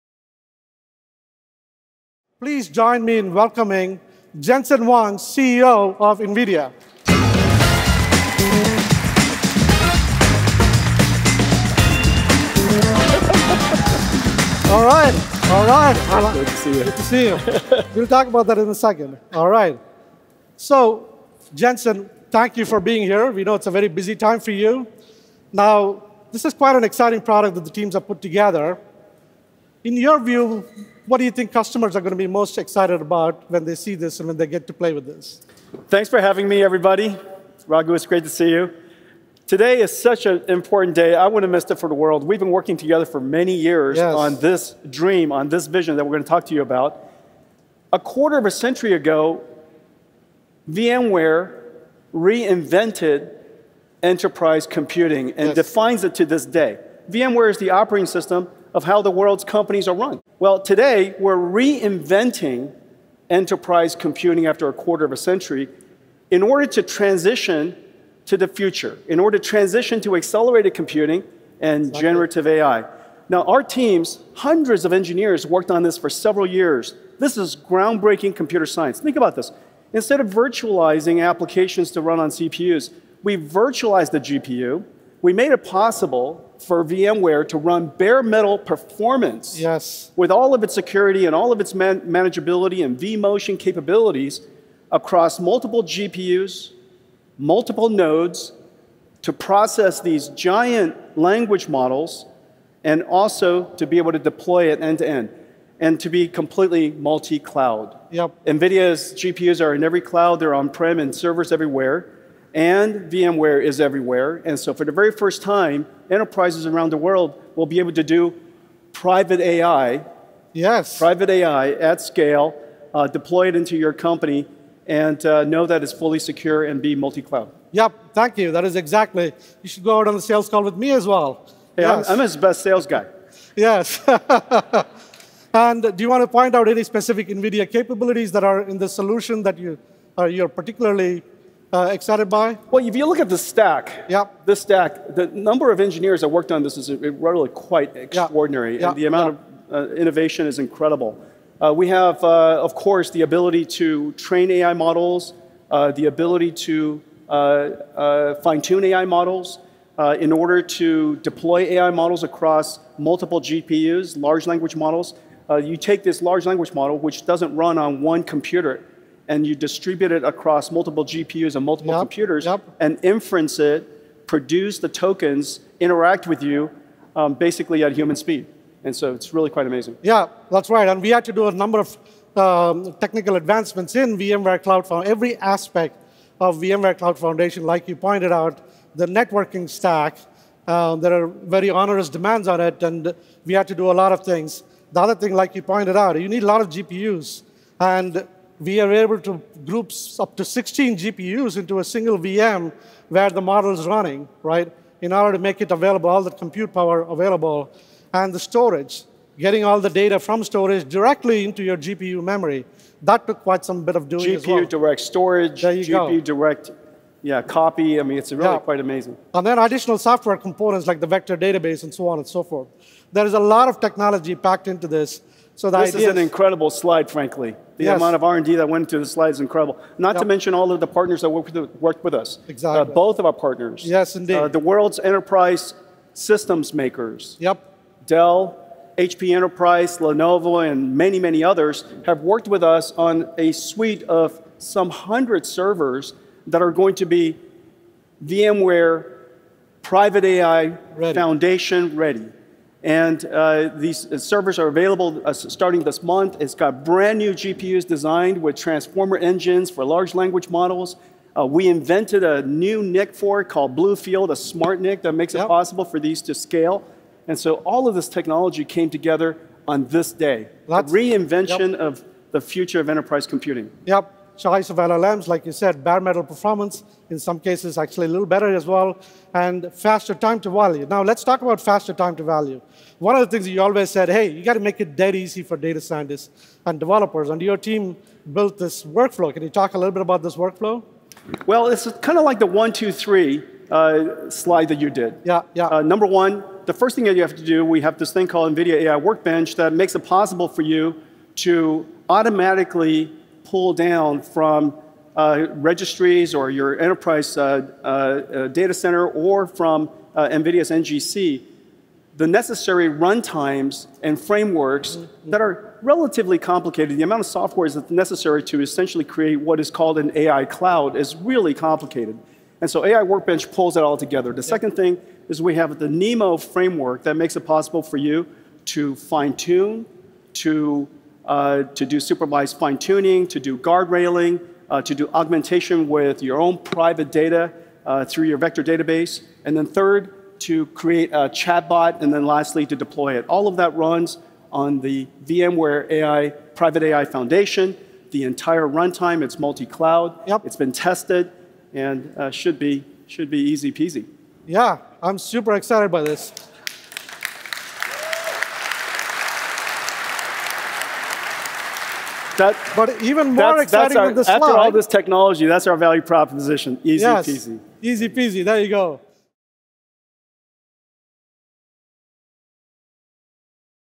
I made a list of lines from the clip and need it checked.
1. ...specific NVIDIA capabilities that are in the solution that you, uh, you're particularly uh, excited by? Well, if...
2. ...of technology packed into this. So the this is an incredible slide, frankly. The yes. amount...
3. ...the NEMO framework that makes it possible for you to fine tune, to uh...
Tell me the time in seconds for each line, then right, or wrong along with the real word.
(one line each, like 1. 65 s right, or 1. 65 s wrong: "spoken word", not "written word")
1. 136 s right
2. 223 s right
3. 325 s right.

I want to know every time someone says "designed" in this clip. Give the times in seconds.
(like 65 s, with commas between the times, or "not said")
257 s.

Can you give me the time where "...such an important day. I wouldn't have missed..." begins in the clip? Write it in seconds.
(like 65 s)
39 s.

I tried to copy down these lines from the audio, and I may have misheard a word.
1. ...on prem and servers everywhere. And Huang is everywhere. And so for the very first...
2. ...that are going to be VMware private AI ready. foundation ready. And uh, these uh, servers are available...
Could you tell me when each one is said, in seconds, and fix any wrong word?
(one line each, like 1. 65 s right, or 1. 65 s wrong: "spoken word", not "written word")
1. 110 s wrong: "VMware", not "Huang"
2. 246 s right.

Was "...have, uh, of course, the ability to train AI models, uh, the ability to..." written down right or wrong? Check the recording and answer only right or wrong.
right.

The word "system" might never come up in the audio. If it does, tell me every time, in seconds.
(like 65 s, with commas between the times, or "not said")
58 s, 236 s.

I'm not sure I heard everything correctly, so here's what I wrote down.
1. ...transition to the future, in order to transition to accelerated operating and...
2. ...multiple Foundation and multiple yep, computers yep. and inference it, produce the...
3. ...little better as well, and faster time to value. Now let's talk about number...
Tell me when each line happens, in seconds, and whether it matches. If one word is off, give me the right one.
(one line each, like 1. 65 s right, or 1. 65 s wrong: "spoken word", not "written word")
1. 66 s wrong: "computing", not "operating"
2. 170 s wrong: "GPUs", not "Foundation"
3. 278 s wrong: "faster", not "number".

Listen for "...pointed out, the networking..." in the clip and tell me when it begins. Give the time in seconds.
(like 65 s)
187 s.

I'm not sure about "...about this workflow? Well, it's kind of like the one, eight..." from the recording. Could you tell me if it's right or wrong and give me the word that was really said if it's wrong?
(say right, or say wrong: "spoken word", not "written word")
wrong: "two", not "eight".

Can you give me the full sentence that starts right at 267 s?
And so all of this technology came together on this day.